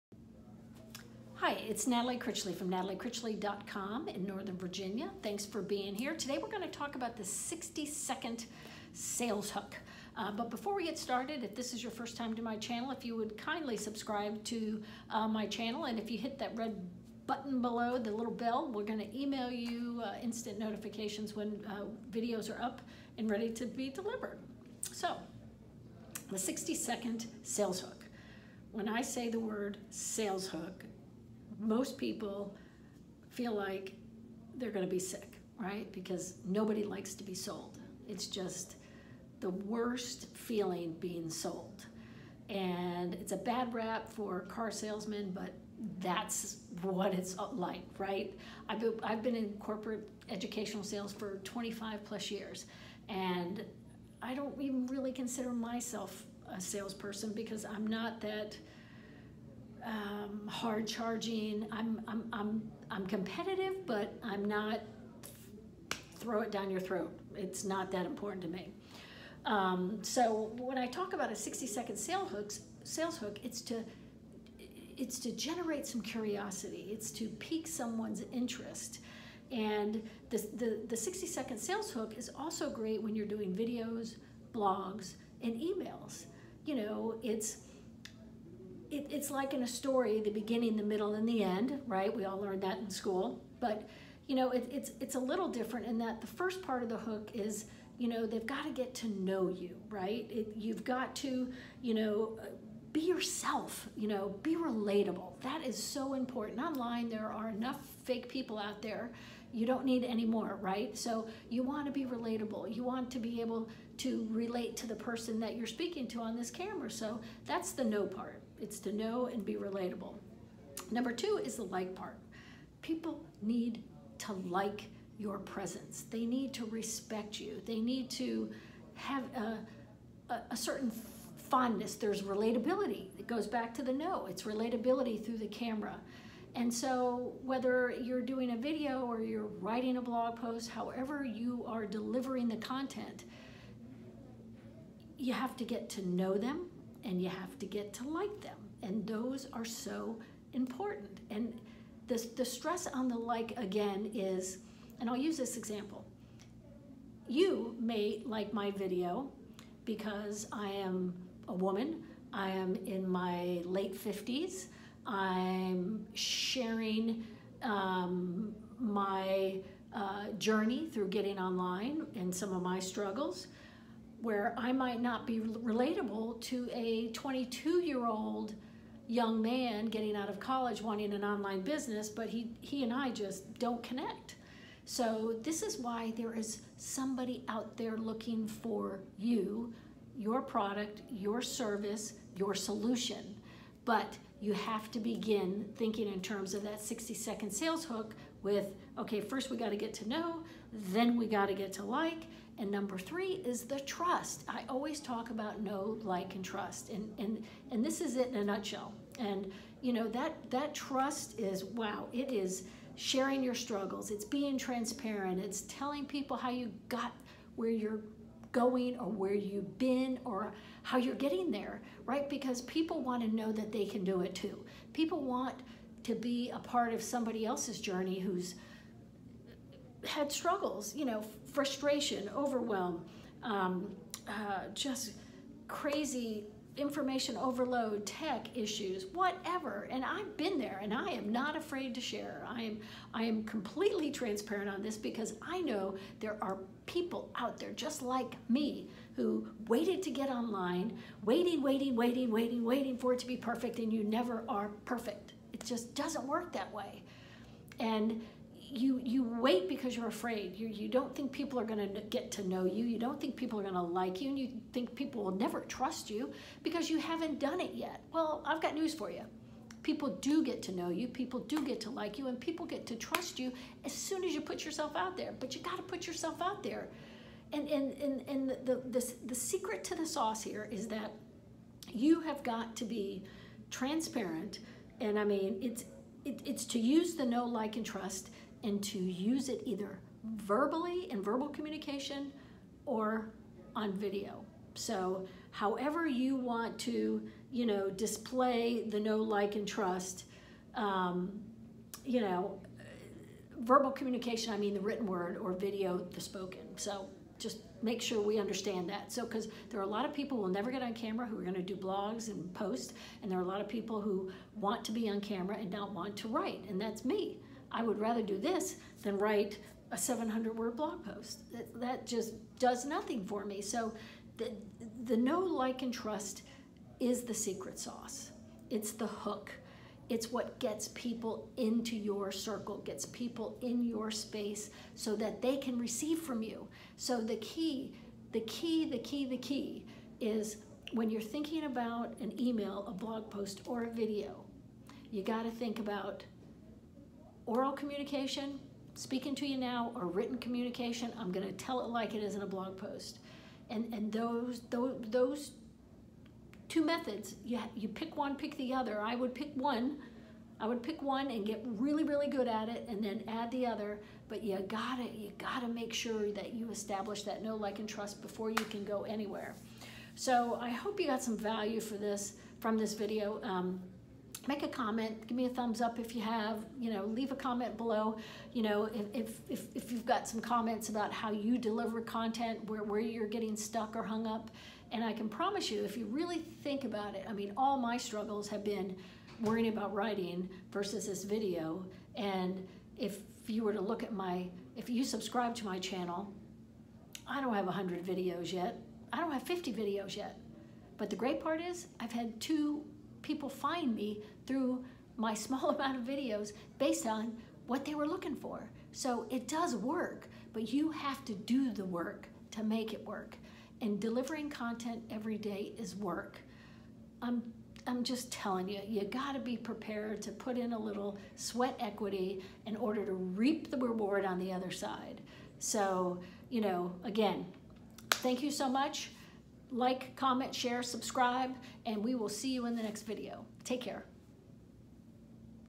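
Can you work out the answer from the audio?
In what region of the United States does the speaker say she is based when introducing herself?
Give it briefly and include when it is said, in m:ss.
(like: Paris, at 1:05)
Northern Virginia, at 0:04.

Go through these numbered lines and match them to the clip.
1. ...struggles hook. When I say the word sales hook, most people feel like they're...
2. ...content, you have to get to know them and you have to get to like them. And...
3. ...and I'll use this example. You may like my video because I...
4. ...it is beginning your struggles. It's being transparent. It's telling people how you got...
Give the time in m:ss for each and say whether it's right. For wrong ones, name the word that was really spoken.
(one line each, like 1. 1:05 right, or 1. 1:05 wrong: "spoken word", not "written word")
1. 0:27 wrong: "sales", not "struggles"
2. 2:22 right
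3. 2:34 right
4. 3:32 wrong: "sharing", not "beginning".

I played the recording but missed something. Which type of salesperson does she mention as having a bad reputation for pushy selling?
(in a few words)
Car salesmen.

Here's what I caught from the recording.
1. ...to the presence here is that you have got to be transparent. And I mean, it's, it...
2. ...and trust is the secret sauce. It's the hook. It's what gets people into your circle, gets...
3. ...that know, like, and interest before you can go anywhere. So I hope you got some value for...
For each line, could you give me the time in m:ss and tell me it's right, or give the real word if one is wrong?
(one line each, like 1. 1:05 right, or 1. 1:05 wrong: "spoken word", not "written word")
1. 4:39 wrong: "sauce", not "presence"
2. 5:25 right
3. 6:07 wrong: "trust", not "interest".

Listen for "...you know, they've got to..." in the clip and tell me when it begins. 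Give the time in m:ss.
1:37.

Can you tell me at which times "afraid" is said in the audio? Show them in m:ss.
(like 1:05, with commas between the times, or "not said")
4:01, 4:20.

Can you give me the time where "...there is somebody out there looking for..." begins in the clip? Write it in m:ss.
3:06.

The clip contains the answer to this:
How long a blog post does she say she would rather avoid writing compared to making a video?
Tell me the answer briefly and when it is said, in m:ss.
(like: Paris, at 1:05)
700 words, at 5:19.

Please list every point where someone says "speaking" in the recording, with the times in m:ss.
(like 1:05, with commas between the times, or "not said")
1:55, 5:48.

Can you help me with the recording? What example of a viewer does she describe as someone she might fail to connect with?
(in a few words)
22 year old young man.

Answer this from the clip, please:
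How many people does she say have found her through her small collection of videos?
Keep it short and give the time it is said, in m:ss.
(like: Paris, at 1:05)
2, at 6:42.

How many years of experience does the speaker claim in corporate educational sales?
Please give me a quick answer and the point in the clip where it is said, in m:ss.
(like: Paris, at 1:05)
25 plus years, at 0:51.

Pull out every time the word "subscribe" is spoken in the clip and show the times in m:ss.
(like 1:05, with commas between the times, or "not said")
0:13, 6:35, 7:10.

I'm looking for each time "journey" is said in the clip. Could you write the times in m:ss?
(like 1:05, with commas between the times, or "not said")
2:50, 3:47.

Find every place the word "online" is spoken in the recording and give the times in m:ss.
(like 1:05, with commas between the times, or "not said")
1:46, 2:51, 3:01, 4:10.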